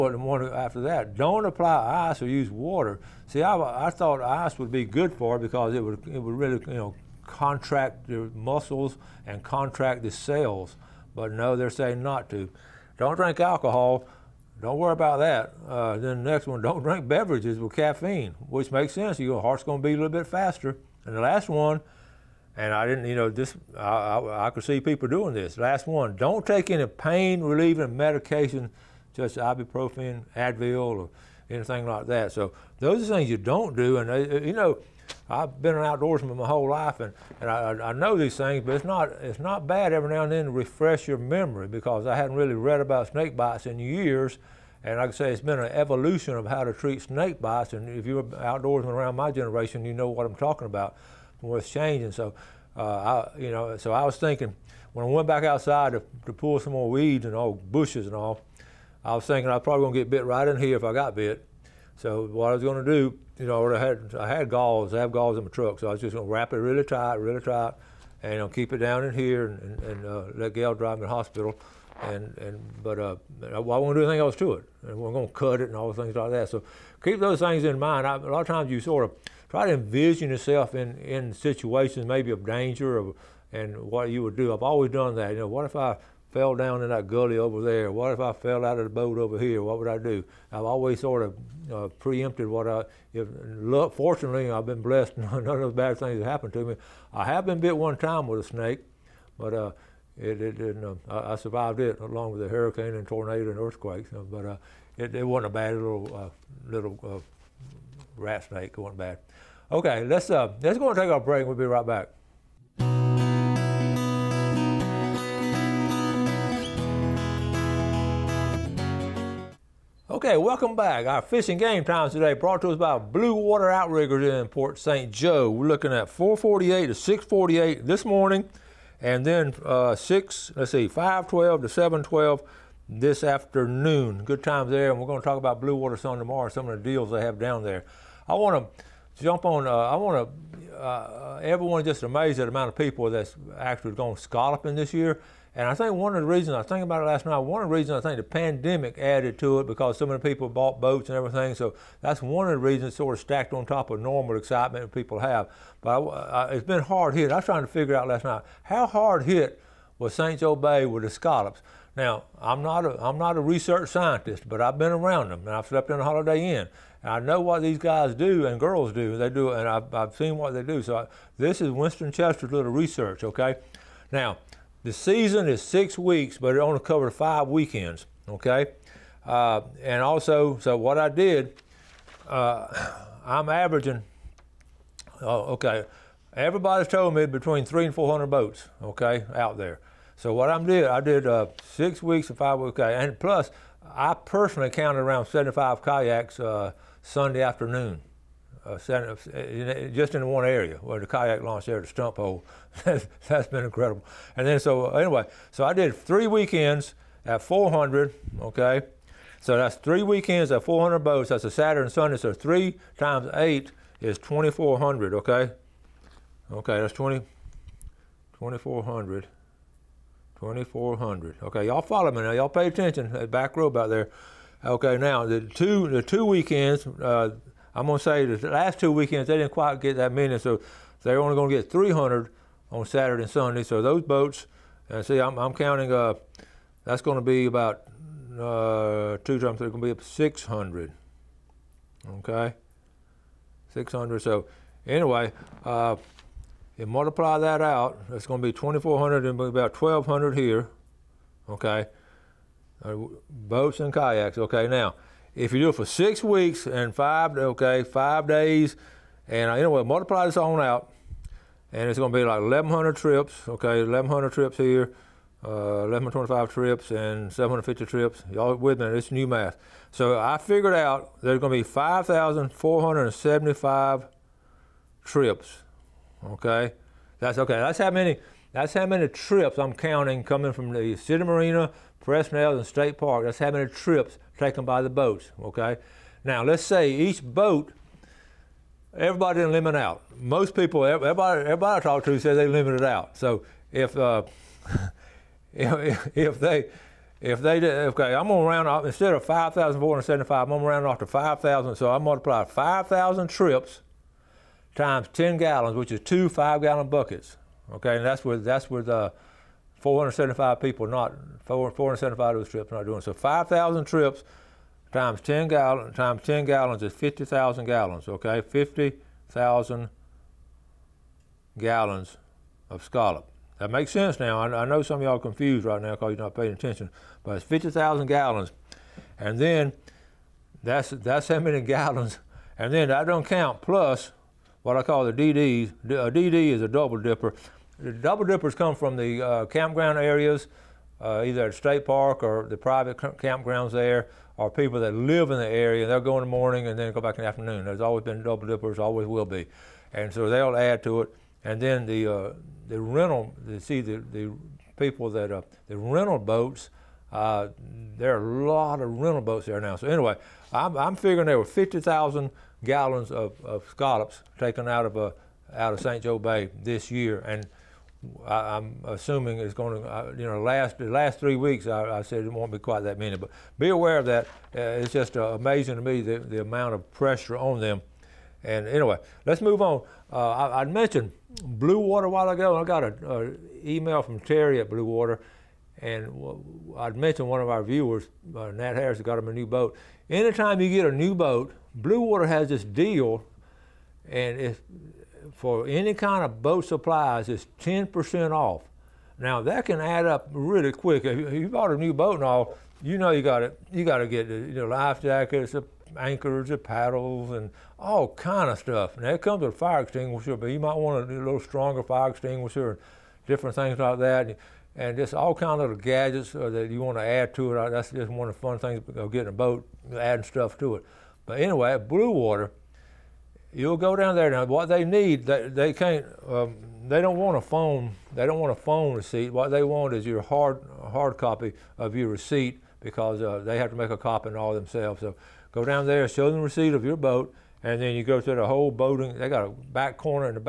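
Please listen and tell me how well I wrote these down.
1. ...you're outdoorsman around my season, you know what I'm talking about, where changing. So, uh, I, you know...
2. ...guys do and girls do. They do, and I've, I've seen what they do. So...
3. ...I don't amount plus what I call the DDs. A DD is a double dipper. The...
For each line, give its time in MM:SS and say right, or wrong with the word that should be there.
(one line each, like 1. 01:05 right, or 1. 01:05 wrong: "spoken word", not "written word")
1. 00:48 wrong: "generation", not "season"
2. 02:47 right
3. 05:32 wrong: "count", not "amount".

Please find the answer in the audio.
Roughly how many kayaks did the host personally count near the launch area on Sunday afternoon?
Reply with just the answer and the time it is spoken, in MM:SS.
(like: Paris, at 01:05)
75, at 03:15.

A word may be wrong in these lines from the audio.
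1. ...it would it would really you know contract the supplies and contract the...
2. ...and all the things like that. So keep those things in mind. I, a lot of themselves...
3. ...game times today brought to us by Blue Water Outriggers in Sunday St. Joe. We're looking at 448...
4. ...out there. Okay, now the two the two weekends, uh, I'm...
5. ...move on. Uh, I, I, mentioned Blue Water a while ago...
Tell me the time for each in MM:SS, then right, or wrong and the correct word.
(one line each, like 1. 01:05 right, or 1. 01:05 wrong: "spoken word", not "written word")
1. 00:05 wrong: "muscles", not "supplies"
2. 01:15 wrong: "times", not "themselves"
3. 02:01 wrong: "Port", not "Sunday"
4. 03:43 right
5. 06:19 right.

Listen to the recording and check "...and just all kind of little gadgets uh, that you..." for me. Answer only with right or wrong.
right.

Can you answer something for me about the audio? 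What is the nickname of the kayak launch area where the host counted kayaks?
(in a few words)
the stump hole.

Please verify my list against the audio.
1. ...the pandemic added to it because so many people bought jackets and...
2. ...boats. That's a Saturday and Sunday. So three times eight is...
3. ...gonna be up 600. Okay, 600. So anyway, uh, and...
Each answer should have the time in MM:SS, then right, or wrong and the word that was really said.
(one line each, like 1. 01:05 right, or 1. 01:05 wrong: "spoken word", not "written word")
1. 02:28 wrong: "boats", not "jackets"
2. 03:30 right
3. 03:59 right.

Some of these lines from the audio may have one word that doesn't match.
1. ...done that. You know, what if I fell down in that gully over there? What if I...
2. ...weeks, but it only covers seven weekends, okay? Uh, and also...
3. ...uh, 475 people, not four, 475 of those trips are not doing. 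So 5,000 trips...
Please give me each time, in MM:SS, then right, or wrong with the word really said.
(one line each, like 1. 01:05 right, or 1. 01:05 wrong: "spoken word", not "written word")
1. 01:24 right
2. 02:55 wrong: "five", not "seven"
3. 05:08 right.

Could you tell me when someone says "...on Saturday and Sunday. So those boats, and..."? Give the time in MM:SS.
03:52.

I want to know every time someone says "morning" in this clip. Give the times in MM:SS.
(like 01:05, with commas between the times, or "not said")
02:08, 05:46.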